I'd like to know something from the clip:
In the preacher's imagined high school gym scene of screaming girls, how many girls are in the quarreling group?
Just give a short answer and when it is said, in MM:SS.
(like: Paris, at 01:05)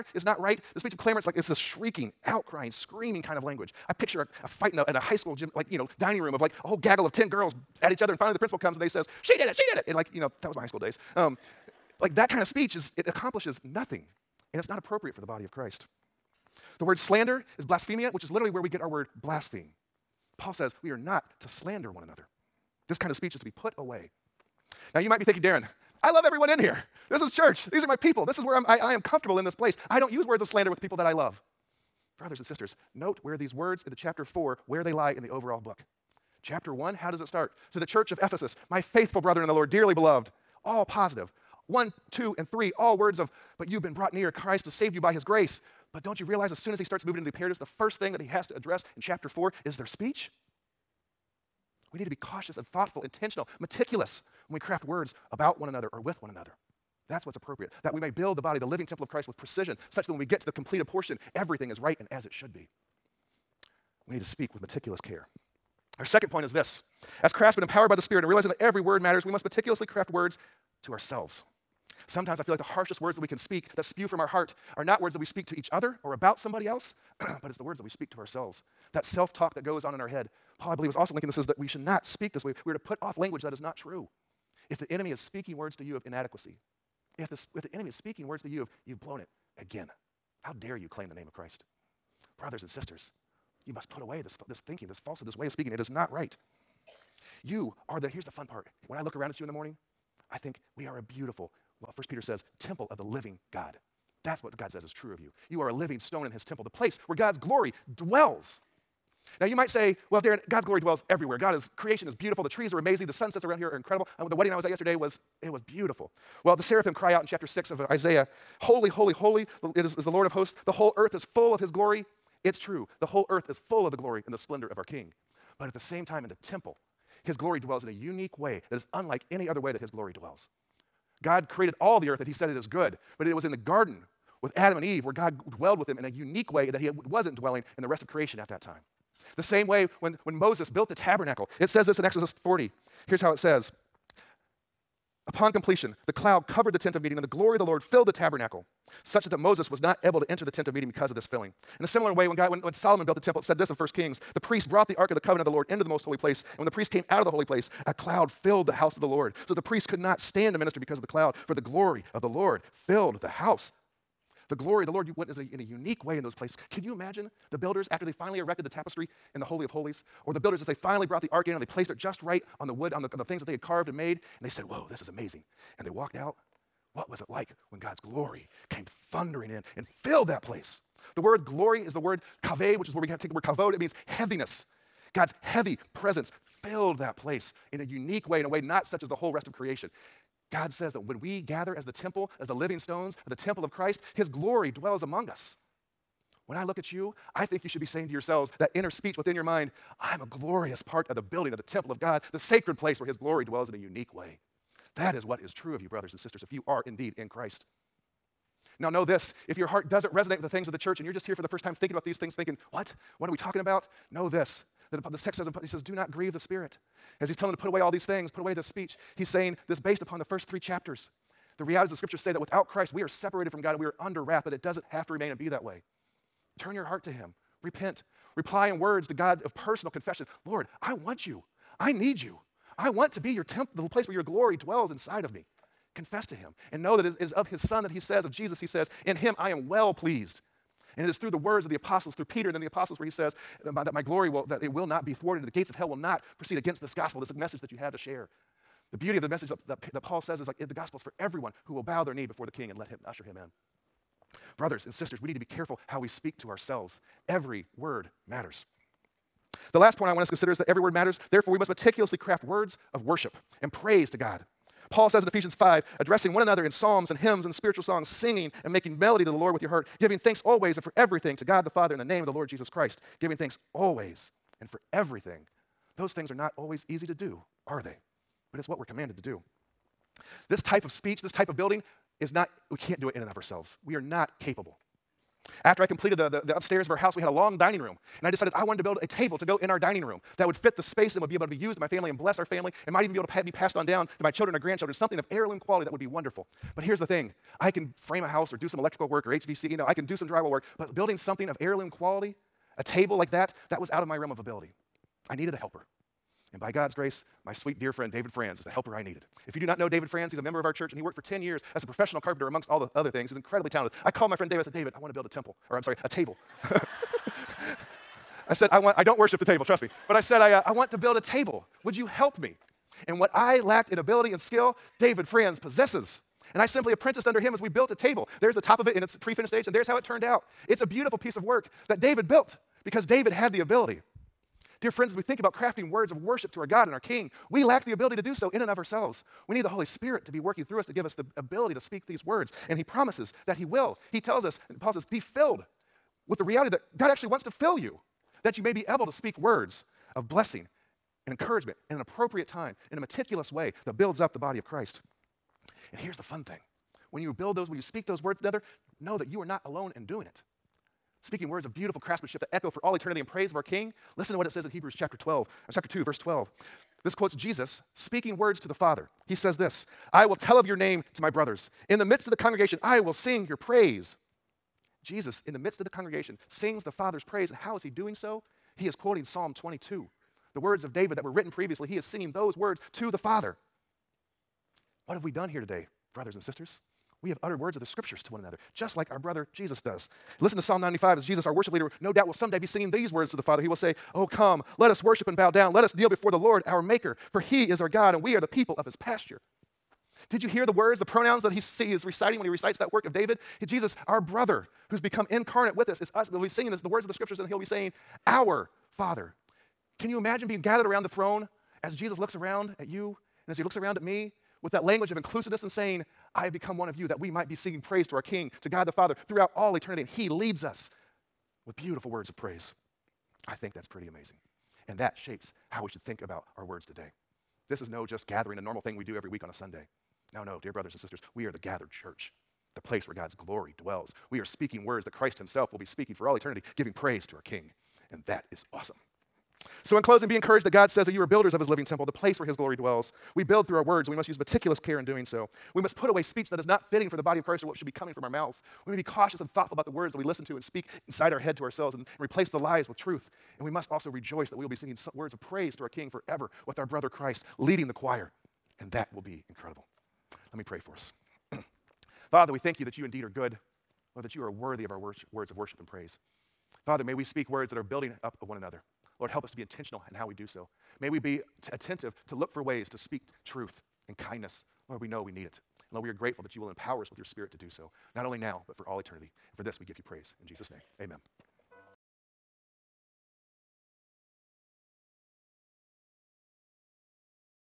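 10, at 00:07.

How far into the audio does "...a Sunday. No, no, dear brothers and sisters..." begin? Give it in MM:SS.
07:09.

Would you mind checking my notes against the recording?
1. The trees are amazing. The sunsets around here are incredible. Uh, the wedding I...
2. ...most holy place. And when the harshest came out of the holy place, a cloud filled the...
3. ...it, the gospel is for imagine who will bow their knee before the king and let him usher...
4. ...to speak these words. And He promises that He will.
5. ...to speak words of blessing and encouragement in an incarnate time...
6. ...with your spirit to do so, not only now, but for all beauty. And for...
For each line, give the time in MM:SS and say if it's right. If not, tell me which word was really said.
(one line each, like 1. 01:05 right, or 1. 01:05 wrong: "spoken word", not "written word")
1. 01:52 right
2. 02:35 wrong: "priest", not "harshest"
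3. 04:10 wrong: "everyone", not "imagine"
4. 05:41 right
5. 05:49 wrong: "appropriate", not "incarnate"
6. 07:57 wrong: "eternity", not "beauty".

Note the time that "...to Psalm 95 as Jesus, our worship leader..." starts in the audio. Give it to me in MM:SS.
06:30.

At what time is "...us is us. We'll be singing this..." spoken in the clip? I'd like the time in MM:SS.
06:45.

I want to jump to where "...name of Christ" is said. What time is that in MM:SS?
01:31.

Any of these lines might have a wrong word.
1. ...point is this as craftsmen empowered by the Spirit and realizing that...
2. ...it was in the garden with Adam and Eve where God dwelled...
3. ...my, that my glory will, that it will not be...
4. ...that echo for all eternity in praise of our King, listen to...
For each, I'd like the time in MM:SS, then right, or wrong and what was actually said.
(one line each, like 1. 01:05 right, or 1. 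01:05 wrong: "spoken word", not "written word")
1. 01:06 right
2. 02:13 right
3. 04:03 right
4. 06:02 right.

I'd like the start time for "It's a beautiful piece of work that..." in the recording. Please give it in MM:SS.
05:30.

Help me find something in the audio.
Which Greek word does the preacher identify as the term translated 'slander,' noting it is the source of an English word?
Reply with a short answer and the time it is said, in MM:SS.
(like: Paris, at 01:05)
blasphemia, at 00:17.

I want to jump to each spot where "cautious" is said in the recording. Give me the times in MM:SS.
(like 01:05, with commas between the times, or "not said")
00:52, 07:29.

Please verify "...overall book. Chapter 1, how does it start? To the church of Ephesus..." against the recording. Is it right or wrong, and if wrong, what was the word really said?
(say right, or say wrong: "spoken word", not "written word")
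right.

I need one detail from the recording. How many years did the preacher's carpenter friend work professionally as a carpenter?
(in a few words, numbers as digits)
10.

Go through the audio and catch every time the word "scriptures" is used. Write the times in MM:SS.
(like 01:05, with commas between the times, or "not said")
03:41, 06:27, 06:47.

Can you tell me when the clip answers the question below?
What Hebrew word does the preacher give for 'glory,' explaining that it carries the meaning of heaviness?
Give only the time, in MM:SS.
03:03.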